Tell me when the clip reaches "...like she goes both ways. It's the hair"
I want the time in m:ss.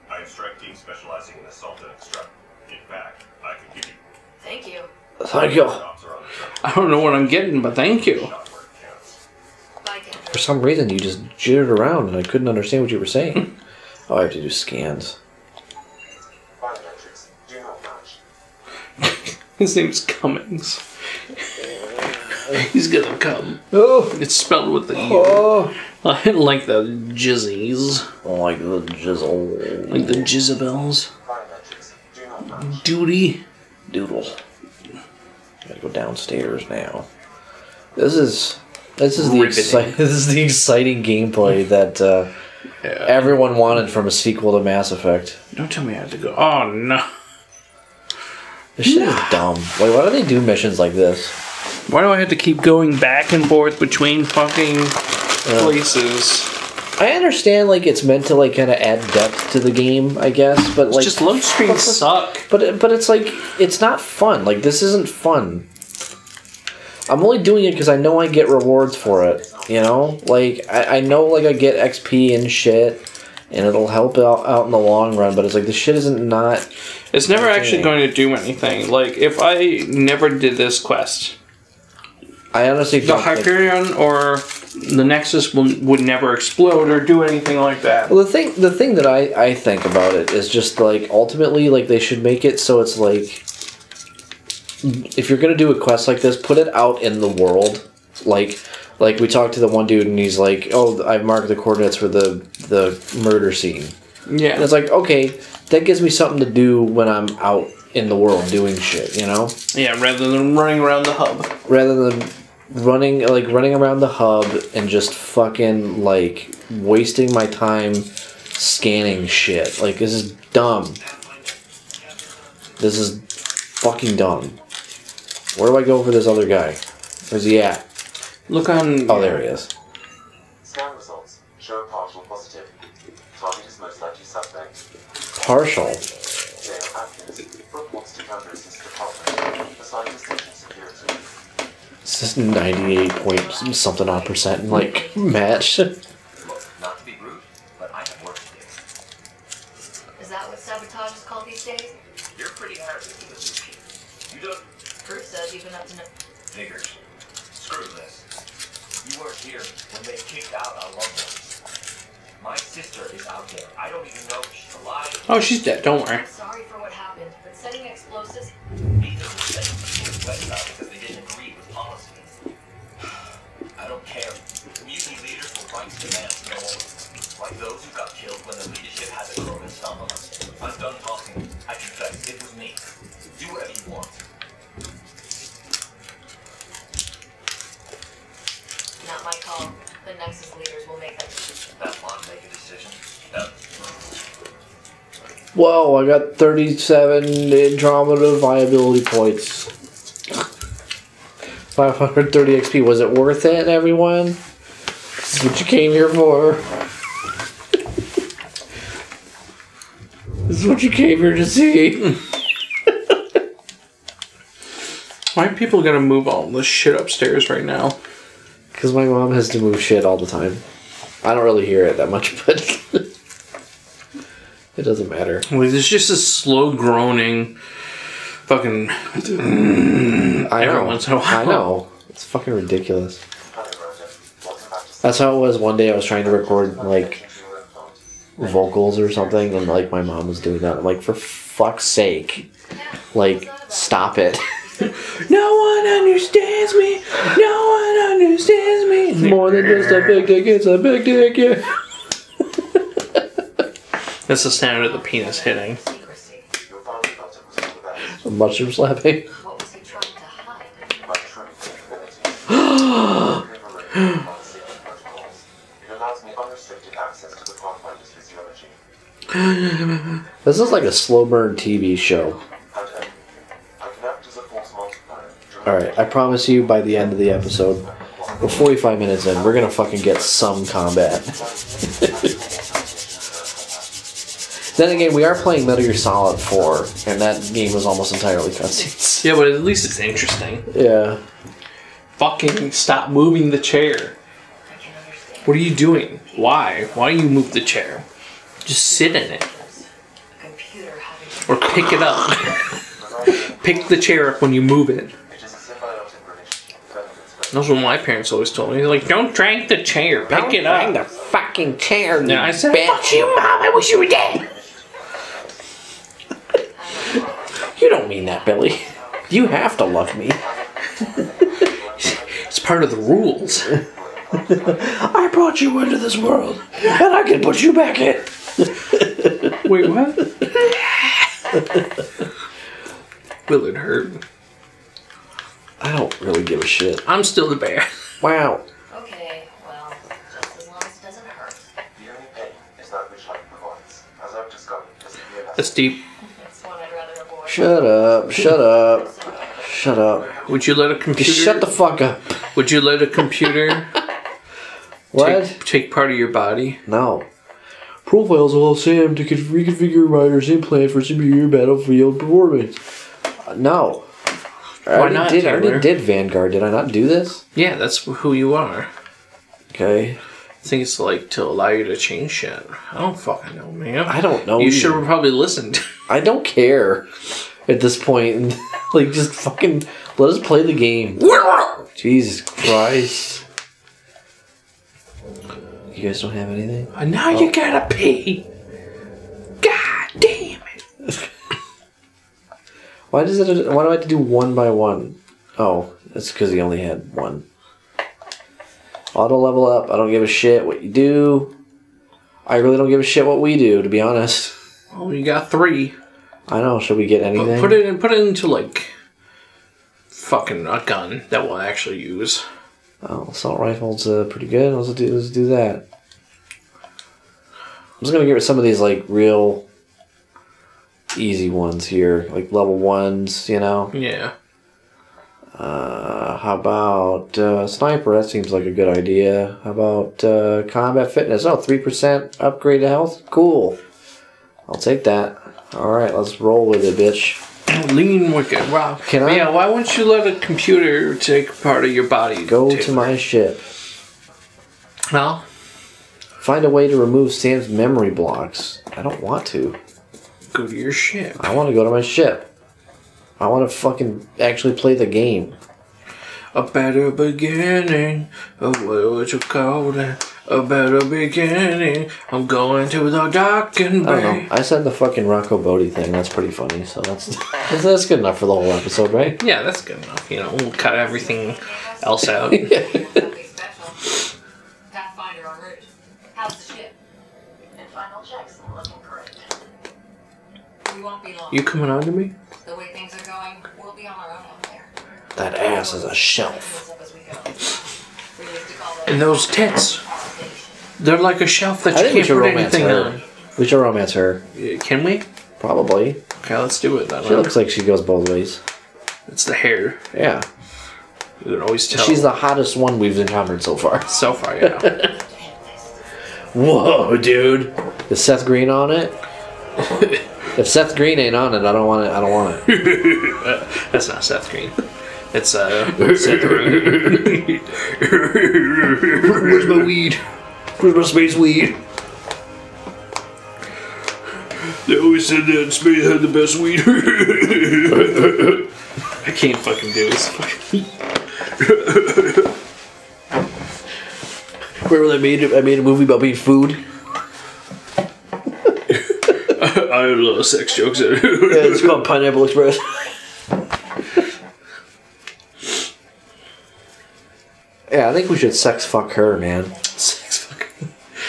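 8:17.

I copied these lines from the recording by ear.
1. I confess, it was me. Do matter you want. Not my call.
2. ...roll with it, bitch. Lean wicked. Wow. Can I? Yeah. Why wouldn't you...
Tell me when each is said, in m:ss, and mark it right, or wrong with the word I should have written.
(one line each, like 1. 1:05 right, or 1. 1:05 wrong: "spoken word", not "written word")
1. 3:01 wrong: "whatever", not "matter"
2. 7:16 right.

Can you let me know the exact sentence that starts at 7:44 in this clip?
I said the fucking Rocco Botte thing.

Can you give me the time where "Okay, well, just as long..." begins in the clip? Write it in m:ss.
5:38.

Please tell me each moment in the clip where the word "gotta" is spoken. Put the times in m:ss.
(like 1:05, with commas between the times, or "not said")
0:35, 6:27.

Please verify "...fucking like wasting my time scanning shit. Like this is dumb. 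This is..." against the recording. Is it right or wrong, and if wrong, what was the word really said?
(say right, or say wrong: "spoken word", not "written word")
right.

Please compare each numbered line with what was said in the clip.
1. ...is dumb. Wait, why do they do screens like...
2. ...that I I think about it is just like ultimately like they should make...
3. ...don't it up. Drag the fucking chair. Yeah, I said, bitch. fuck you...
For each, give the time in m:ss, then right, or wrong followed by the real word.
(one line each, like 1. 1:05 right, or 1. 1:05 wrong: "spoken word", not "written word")
1. 0:49 wrong: "missions", not "screens"
2. 1:28 right
3. 5:10 right.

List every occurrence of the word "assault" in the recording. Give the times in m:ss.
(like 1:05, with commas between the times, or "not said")
0:01, 6:53.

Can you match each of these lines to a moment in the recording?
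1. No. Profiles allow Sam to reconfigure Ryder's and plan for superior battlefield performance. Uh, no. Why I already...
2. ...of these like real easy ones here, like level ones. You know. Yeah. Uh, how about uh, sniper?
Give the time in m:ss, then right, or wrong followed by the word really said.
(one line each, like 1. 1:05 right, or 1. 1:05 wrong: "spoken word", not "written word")
1. 5:56 right
2. 6:58 right.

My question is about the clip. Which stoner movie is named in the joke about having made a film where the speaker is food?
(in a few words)
Pineapple Express.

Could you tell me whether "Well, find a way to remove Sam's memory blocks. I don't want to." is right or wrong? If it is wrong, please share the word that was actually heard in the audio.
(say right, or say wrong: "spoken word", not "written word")
right.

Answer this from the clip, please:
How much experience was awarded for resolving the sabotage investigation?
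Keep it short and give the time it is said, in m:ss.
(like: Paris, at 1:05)
530 XP, at 3:21.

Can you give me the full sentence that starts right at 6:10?
I think it's like to allow you to change shit.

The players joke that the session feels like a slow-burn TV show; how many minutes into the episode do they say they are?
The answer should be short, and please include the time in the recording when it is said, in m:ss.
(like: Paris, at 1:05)
45, at 4:38.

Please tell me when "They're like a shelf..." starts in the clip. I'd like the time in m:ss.
8:11.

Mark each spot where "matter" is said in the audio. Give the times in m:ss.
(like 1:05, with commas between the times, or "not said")
3:45.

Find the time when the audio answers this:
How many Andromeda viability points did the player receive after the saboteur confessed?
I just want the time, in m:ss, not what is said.
3:16.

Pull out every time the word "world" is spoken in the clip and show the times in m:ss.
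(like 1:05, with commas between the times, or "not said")
1:37, 1:48, 5:26.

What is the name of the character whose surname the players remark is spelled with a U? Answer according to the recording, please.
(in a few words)
Cummings.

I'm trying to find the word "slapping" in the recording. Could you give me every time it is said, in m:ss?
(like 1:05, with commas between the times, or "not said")
4:18.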